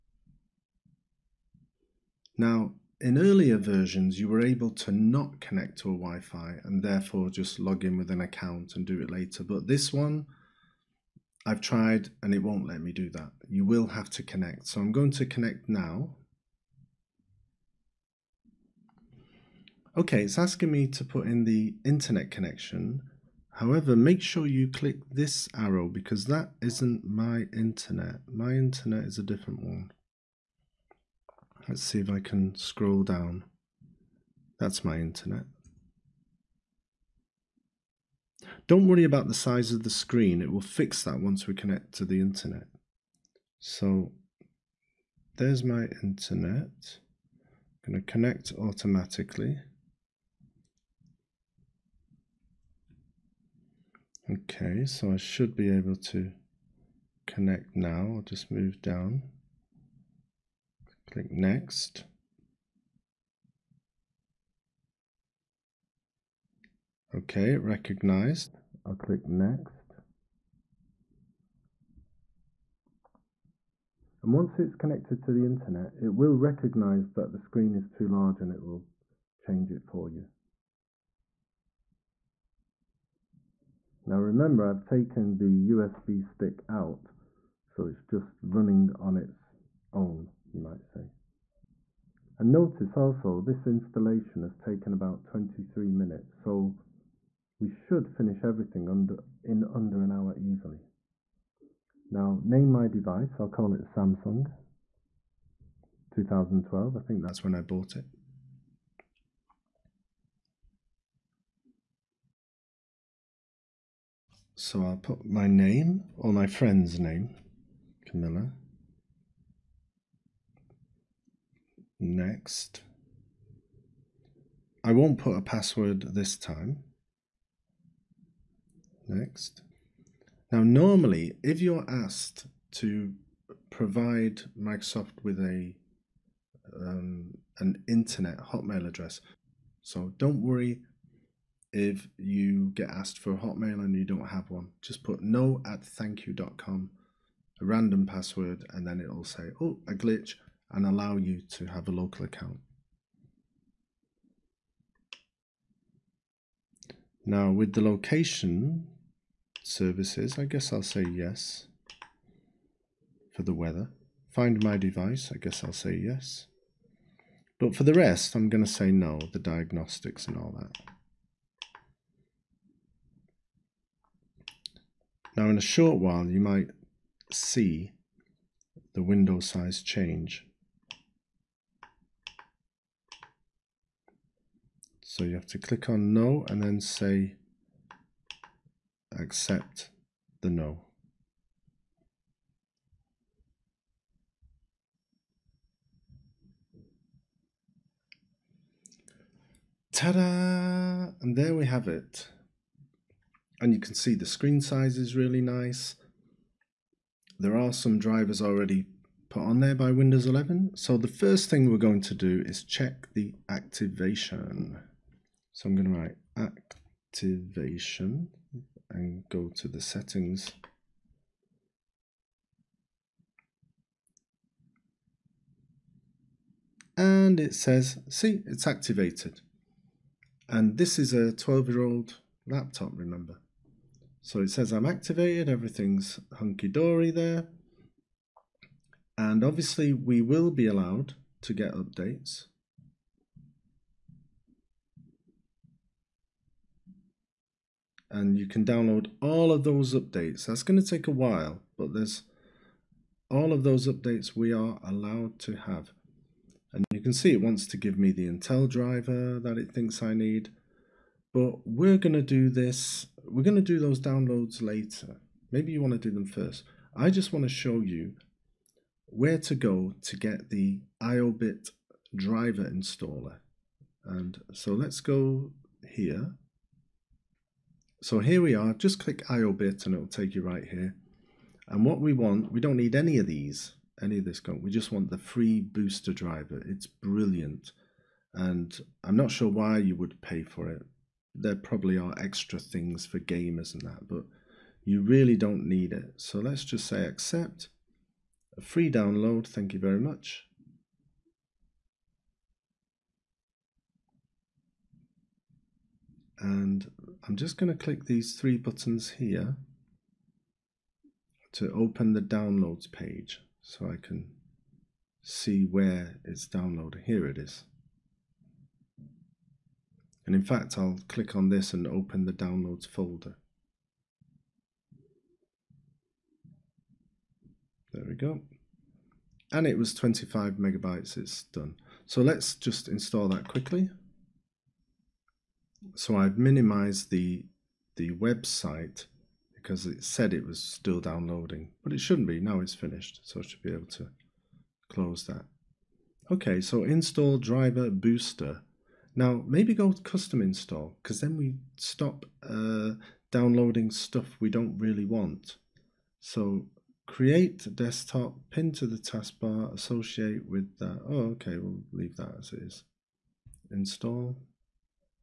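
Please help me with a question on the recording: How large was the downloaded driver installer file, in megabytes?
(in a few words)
25 megabytes.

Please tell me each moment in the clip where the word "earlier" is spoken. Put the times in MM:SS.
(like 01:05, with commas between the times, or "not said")
00:03.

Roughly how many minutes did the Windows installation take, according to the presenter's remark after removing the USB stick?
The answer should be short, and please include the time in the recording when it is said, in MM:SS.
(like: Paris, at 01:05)
23 minutes, at 01:35.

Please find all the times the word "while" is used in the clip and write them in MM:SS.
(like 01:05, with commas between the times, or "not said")
02:56, 04:11.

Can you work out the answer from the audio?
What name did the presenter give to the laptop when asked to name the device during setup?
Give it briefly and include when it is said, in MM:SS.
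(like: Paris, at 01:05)
Samsung 2012, at 01:43.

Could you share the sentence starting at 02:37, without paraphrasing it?
Now with the location services, I guess I'll say yes for the weather.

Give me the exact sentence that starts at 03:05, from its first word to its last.
So you have to click on no and then say accept the no.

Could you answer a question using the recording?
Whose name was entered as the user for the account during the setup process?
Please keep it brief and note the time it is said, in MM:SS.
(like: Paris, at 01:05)
Camilla, at 01:58.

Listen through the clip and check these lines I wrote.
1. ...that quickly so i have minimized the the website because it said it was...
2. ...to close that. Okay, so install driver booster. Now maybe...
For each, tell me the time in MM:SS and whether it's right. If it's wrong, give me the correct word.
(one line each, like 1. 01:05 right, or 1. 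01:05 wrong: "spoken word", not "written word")
1. 05:33 right
2. 05:43 right.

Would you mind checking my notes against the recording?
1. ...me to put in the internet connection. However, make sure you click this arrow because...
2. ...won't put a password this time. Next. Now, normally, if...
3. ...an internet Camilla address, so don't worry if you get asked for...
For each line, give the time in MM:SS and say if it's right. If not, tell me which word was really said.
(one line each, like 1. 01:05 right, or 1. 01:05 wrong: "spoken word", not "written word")
1. 00:20 right
2. 02:04 right
3. 02:17 wrong: "Hotmail", not "Camilla".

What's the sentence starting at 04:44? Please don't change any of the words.
We just want the free booster driver.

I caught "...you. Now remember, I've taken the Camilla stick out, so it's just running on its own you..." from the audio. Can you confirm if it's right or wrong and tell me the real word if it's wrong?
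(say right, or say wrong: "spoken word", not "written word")
wrong: "USB", not "Camilla".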